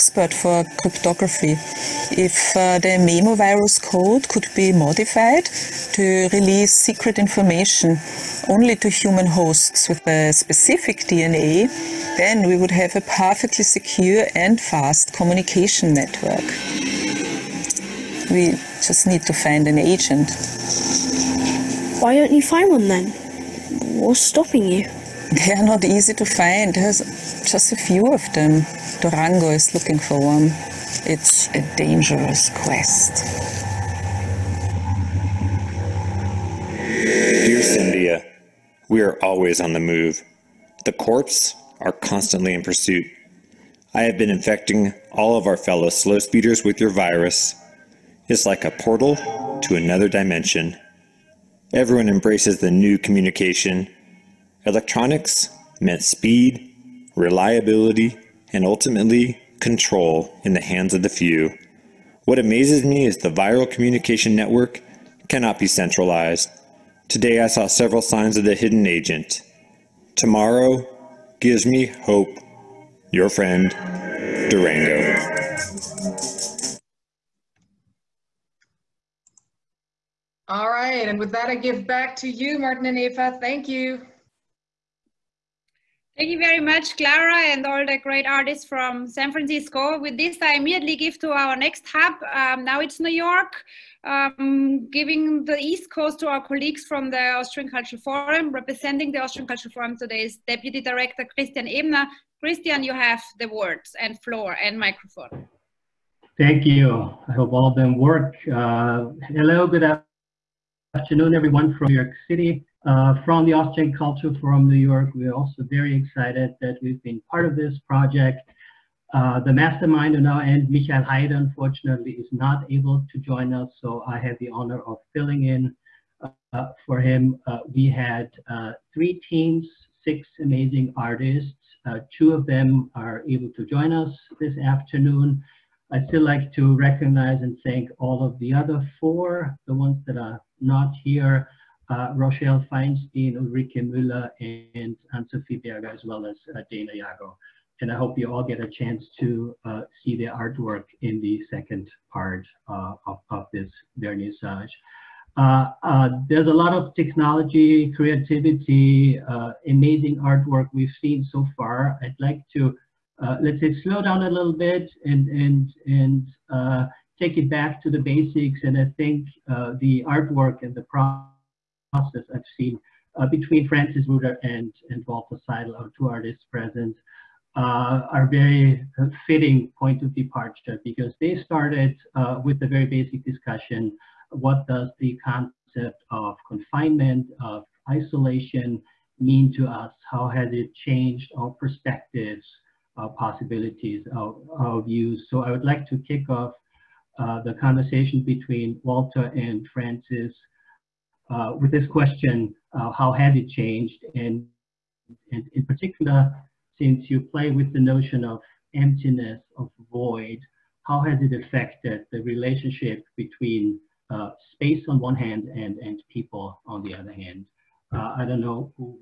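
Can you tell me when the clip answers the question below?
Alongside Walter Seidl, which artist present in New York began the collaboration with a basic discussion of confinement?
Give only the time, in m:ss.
2:53.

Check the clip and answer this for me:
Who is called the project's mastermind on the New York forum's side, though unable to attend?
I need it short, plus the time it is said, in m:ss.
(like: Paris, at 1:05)
Michael Haider, at 2:00.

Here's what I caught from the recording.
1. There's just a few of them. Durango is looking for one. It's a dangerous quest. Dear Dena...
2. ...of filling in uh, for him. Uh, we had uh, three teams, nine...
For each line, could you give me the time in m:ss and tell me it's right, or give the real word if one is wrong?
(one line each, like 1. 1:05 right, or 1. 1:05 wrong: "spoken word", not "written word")
1. 0:26 wrong: "Cynthia", not "Dena"
2. 2:04 wrong: "six", not "nine".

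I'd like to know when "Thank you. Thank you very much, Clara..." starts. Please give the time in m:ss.
1:23.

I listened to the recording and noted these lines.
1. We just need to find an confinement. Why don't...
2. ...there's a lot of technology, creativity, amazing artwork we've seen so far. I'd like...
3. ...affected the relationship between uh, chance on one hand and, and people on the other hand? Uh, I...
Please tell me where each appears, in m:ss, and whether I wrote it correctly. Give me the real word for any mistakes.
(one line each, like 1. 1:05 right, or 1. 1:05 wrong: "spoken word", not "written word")
1. 0:18 wrong: "agent", not "confinement"
2. 2:36 right
3. 3:31 wrong: "space", not "chance".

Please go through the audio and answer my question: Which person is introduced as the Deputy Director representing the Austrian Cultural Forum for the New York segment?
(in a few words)
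Christian Ebner.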